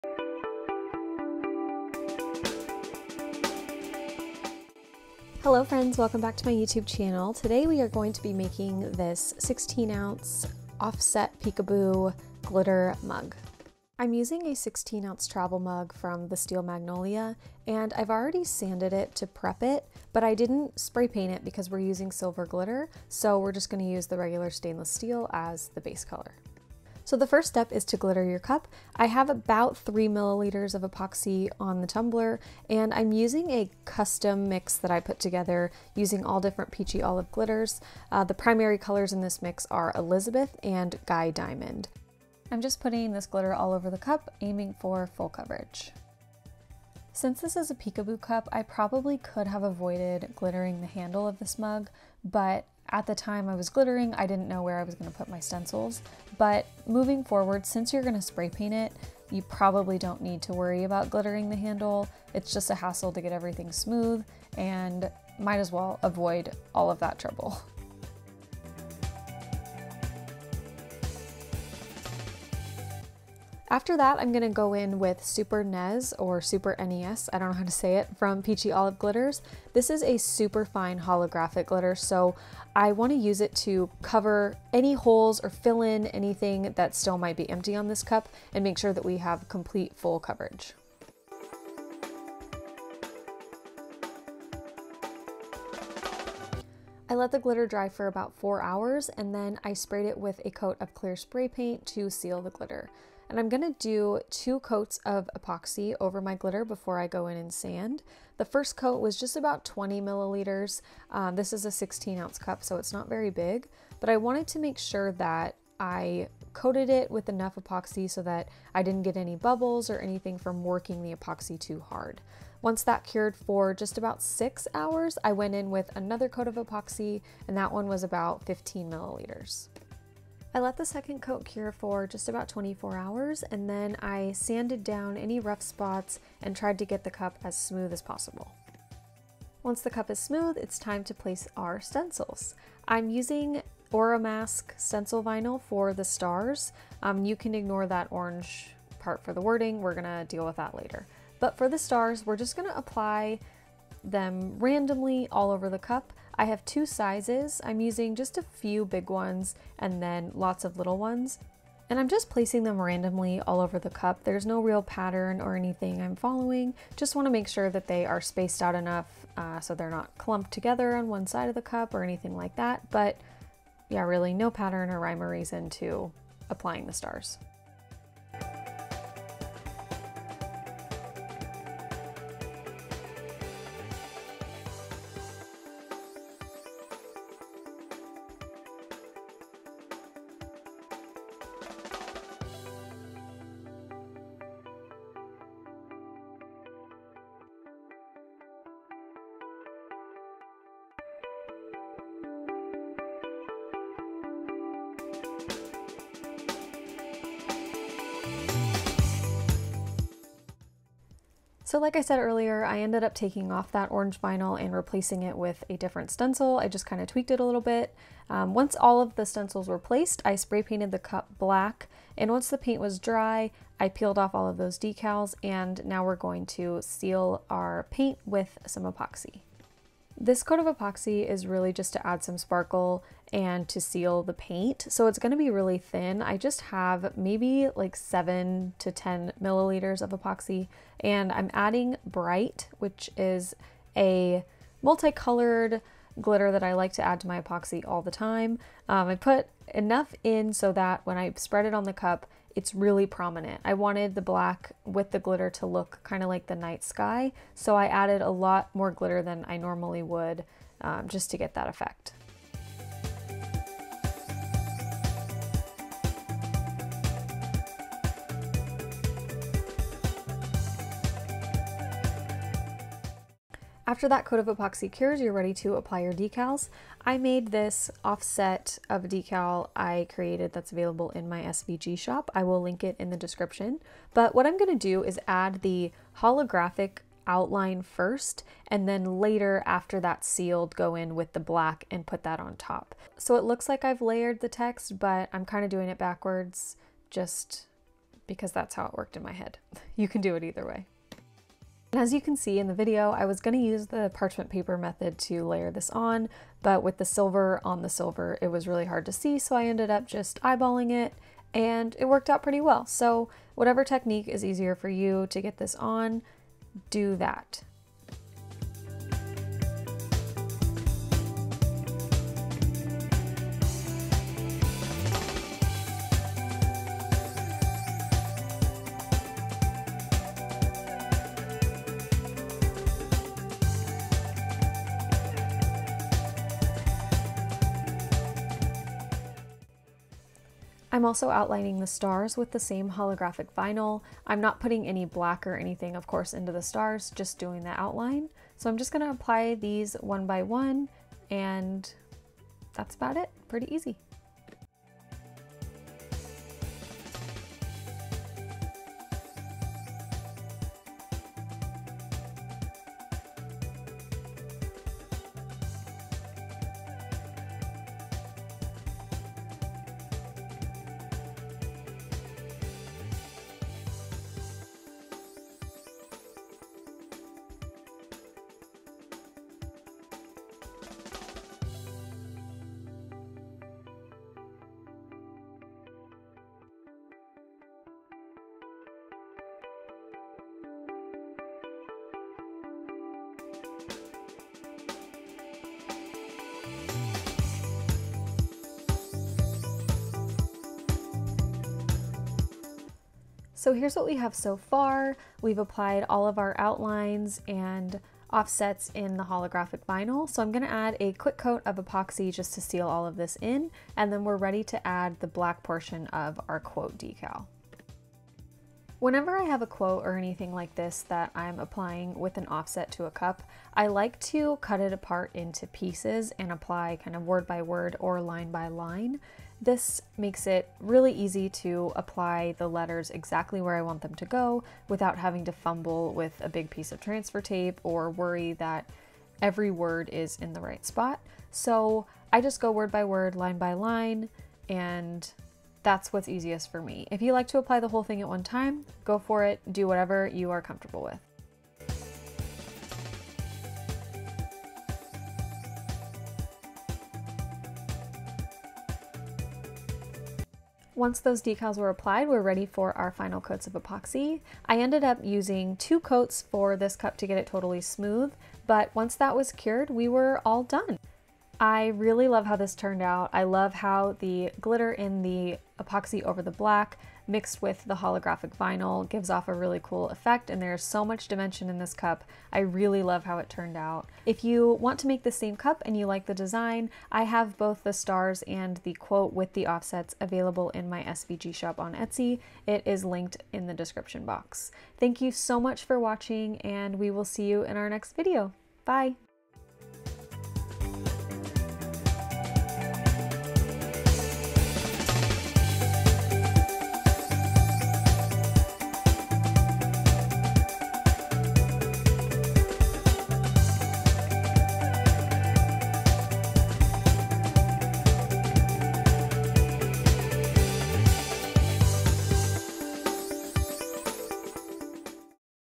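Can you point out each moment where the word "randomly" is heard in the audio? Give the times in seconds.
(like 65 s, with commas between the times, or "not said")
154 s, 162 s.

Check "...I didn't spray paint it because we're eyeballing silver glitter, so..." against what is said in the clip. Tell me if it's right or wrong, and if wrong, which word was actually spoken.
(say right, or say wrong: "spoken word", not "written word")
wrong: "using", not "eyeballing".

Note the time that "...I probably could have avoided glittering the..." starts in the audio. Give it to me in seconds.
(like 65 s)
48 s.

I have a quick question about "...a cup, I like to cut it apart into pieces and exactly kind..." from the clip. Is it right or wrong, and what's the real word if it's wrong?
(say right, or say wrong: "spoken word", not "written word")
wrong: "apply", not "exactly".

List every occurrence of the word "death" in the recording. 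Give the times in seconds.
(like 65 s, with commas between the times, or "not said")
not said.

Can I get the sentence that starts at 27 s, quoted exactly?
So the first step is to glitter your cup.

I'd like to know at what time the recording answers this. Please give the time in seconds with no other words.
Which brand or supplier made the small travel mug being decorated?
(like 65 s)
16 s.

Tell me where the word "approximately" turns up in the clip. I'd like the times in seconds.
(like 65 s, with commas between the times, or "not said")
not said.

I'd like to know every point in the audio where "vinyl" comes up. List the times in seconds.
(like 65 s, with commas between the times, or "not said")
145 s, 214 s, 343 s, 409 s, 478 s.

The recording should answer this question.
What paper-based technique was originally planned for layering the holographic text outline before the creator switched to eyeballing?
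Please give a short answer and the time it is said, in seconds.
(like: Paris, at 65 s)
parchment paper method, at 304 s.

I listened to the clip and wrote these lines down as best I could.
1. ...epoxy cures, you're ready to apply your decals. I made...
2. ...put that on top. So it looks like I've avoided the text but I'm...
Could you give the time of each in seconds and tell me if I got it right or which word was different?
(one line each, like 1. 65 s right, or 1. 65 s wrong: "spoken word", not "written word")
1. 274 s right
2. 292 s wrong: "layered", not "avoided".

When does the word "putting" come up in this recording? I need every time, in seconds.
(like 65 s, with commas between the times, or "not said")
42 s, 344 s.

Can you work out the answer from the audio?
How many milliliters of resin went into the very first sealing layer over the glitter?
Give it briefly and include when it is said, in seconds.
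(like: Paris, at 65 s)
20, at 109 s.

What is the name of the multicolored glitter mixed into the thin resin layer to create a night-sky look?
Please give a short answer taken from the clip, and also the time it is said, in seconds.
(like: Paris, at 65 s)
Brite, at 242 s.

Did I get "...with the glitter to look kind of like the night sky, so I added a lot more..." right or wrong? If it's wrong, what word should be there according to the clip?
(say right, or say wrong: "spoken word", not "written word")
right.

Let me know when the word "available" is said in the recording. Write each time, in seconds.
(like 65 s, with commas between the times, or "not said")
280 s, 490 s.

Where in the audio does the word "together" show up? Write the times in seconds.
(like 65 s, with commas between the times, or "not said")
35 s, 170 s.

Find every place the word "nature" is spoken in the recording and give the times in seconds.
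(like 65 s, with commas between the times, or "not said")
not said.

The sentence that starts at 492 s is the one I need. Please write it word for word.
It is linked in the description box.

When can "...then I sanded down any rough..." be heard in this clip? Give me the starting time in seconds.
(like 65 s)
133 s.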